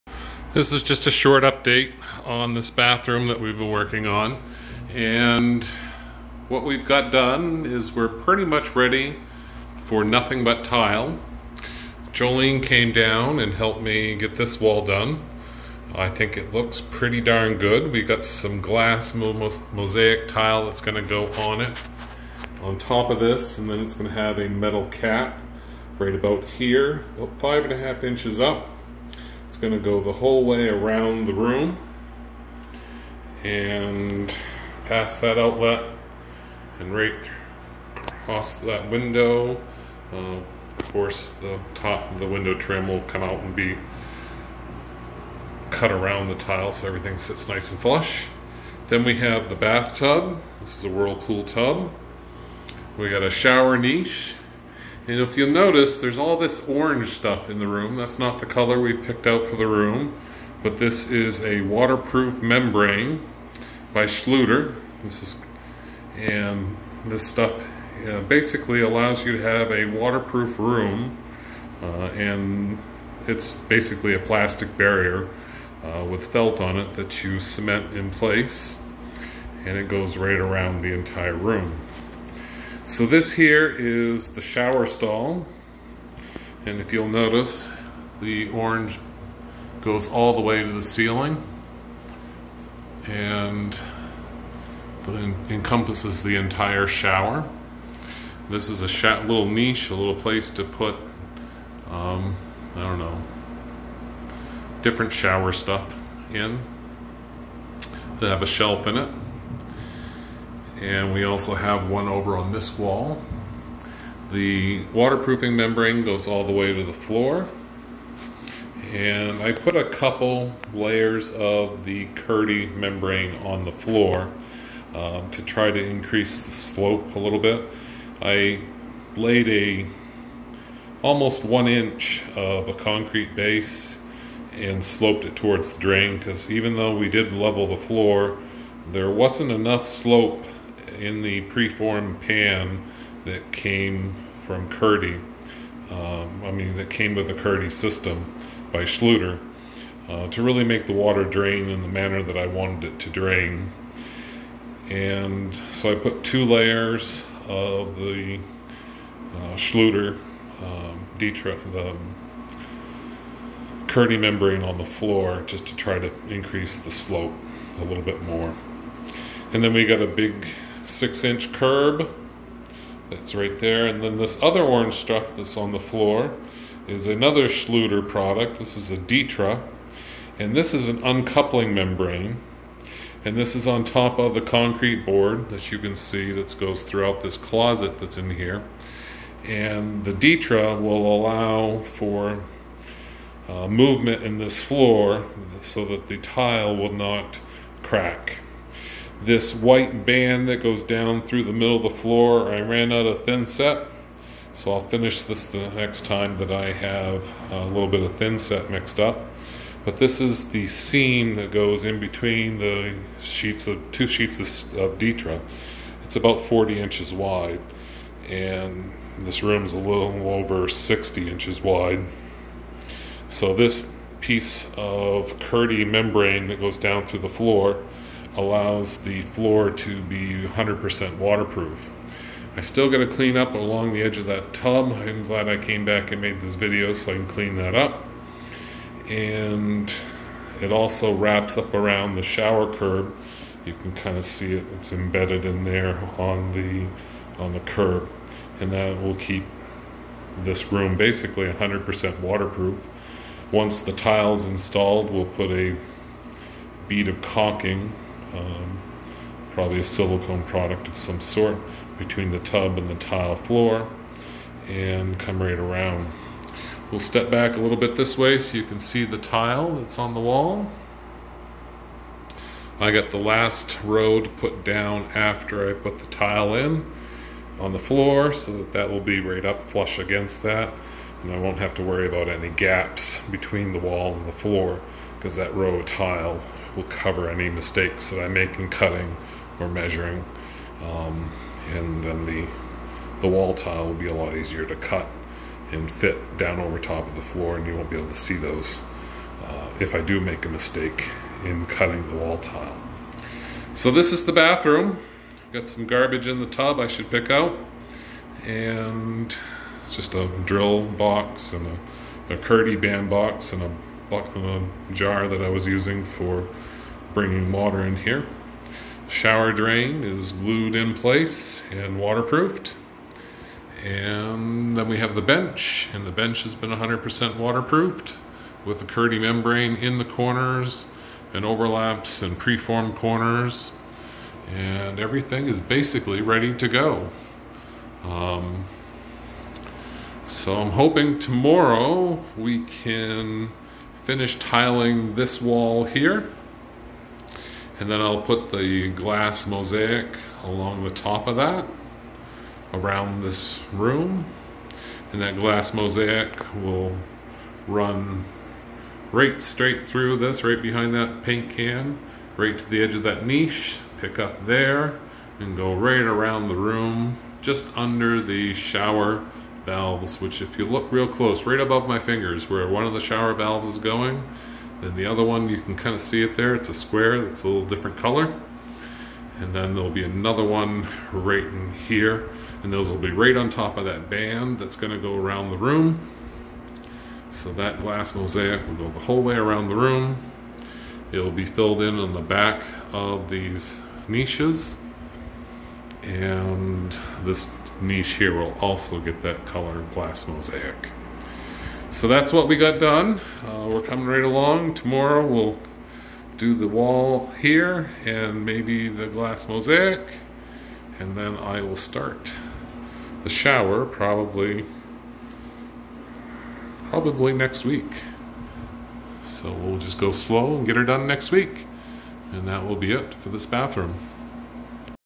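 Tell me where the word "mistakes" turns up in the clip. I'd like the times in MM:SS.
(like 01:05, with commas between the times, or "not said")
04:47, 05:00.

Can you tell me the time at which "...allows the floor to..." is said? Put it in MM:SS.
03:48.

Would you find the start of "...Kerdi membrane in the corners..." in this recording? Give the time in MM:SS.
05:28.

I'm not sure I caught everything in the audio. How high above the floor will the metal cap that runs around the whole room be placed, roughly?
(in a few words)
5.5 inches.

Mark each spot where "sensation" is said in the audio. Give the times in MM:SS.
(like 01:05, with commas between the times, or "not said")
not said.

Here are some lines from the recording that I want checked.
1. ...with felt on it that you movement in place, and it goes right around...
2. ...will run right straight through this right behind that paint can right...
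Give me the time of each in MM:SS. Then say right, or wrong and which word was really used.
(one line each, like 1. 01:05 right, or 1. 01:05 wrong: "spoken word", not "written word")
1. 01:16 wrong: "cement", not "movement"
2. 05:56 right.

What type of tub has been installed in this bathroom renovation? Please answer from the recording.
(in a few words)
Whirlpool tub.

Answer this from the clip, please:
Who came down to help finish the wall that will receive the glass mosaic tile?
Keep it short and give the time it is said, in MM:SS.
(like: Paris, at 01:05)
Jolene, at 00:12.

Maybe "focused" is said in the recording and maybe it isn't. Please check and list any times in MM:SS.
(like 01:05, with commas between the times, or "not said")
not said.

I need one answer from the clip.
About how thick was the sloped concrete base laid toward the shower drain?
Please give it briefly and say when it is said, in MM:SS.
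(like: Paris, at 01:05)
Almost 1 inch, at 02:11.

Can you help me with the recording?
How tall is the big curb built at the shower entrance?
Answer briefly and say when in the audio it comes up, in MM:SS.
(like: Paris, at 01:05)
6 inches, at 02:50.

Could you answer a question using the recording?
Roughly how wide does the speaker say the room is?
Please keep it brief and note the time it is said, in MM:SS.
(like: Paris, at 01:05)
A little over 60 inches, at 03:39.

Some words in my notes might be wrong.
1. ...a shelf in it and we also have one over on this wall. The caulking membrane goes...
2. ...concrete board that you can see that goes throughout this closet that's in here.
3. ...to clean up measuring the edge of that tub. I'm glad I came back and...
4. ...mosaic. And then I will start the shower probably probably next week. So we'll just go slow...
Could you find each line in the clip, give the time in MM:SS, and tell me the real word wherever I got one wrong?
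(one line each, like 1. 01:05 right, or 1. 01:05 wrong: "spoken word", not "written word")
1. 01:48 wrong: "waterproofing", not "caulking"
2. 03:04 right
3. 03:52 wrong: "along", not "measuring"
4. 06:49 right.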